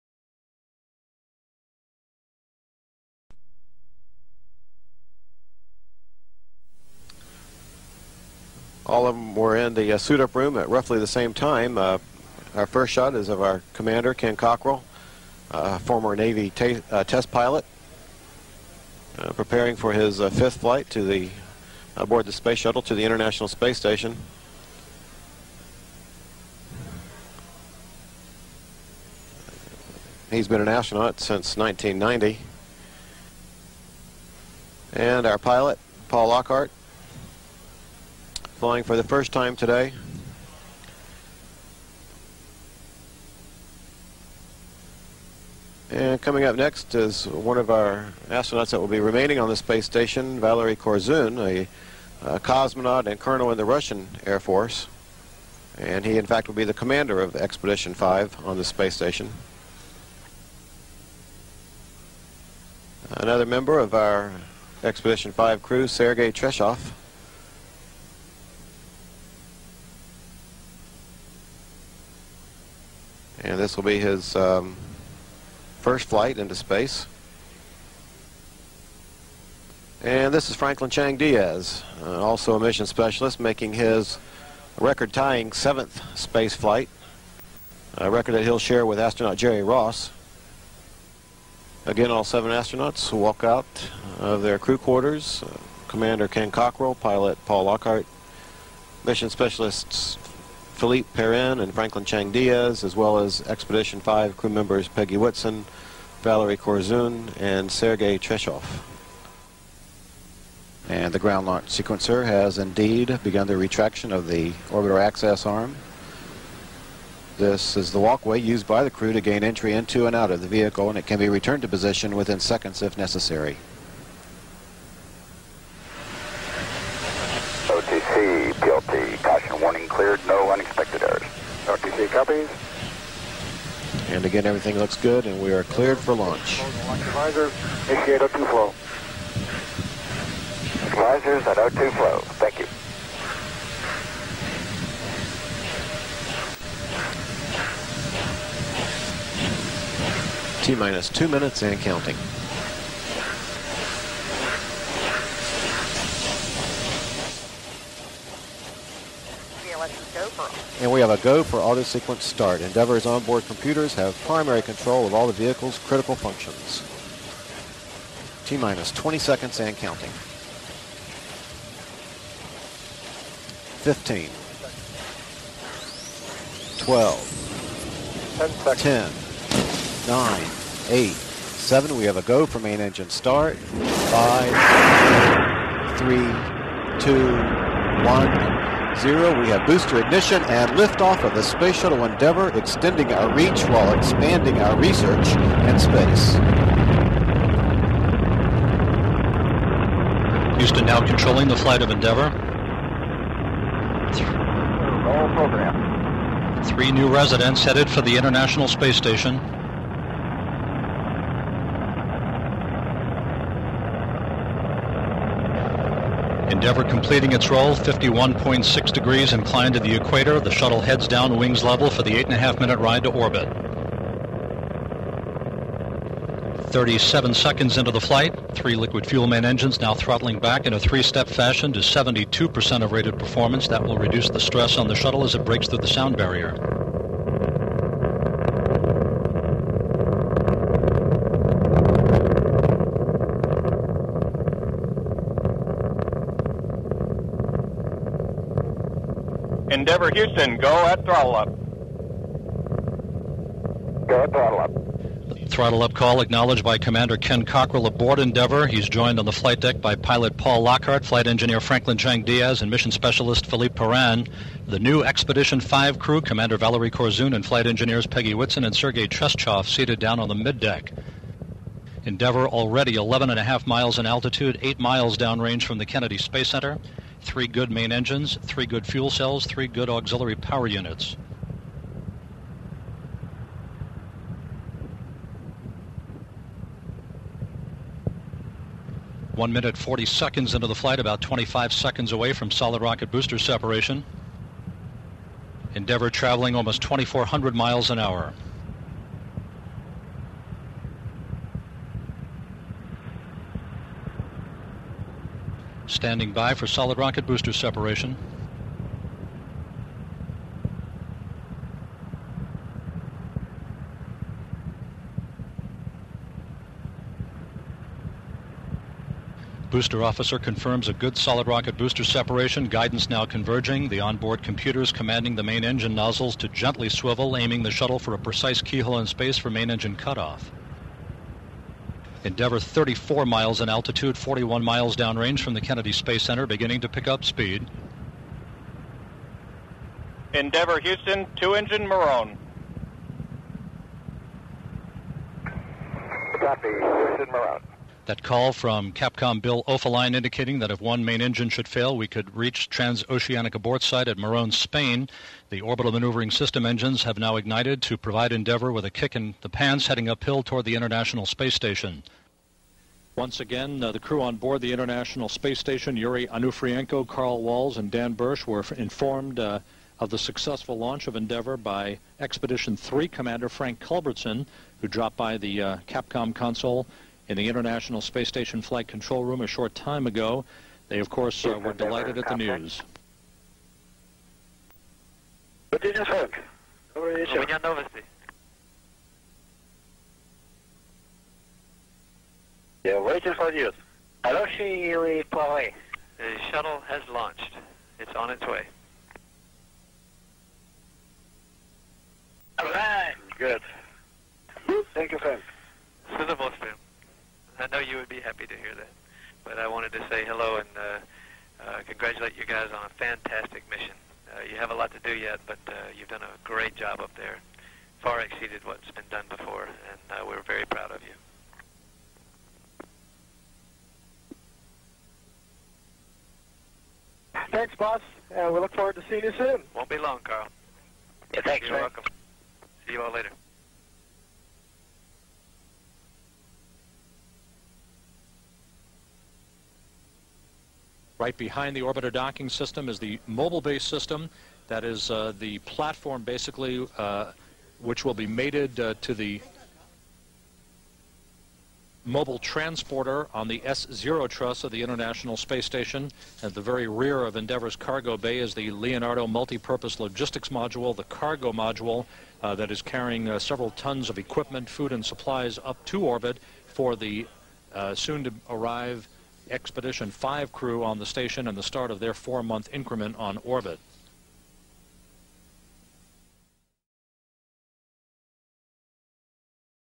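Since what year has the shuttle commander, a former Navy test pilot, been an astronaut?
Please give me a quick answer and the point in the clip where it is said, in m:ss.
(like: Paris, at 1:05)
1990, at 0:31.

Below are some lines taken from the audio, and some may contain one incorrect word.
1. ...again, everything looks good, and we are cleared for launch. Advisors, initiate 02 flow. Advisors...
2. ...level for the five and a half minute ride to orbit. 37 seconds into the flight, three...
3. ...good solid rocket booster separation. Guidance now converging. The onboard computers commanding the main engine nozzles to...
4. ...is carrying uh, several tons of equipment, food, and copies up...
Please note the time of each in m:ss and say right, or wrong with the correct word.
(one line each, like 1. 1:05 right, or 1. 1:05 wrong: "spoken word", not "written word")
1. 2:14 right
2. 3:41 wrong: "eight", not "five"
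3. 5:20 right
4. 7:42 wrong: "supplies", not "copies".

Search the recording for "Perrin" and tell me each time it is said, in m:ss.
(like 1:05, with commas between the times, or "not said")
1:41, 4:23.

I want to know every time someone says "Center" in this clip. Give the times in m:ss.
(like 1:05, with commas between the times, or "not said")
4:36, 5:36.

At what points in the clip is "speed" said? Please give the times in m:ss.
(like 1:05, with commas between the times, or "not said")
5:37.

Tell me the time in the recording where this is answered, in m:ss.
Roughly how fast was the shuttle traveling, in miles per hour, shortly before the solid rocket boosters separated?
4:56.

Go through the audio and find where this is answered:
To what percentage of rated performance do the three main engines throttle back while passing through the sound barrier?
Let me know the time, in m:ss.
3:51.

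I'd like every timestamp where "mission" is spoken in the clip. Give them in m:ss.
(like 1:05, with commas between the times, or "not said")
1:22, 1:39, 4:22, 6:53.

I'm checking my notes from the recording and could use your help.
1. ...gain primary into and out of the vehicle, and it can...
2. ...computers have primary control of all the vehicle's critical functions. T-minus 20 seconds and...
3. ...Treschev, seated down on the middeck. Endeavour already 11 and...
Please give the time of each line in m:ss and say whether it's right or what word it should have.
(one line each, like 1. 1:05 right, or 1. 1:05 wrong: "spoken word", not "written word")
1. 1:59 wrong: "entry", not "primary"
2. 2:43 right
3. 4:29 right.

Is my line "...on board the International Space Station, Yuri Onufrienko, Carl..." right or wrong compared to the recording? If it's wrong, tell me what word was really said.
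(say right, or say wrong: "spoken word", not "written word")
right.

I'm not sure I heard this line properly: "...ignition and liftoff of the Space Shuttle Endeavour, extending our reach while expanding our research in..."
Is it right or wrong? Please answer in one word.
right.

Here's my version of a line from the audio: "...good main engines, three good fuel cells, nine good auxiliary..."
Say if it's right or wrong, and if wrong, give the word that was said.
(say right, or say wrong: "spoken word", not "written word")
wrong: "three", not "nine".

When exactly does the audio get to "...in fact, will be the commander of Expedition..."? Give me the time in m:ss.
0:56.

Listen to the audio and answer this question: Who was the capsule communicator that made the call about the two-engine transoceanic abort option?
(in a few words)
Bill Oefelein.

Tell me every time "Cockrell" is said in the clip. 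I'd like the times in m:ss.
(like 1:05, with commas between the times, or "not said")
0:14, 1:36, 4:17.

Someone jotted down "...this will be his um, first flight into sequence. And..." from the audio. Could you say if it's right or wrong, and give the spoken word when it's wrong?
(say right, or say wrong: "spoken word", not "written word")
wrong: "space", not "sequence".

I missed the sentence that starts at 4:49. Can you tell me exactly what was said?
One minute, 40 seconds into the flight, about 25 seconds away from solid rocket booster separation.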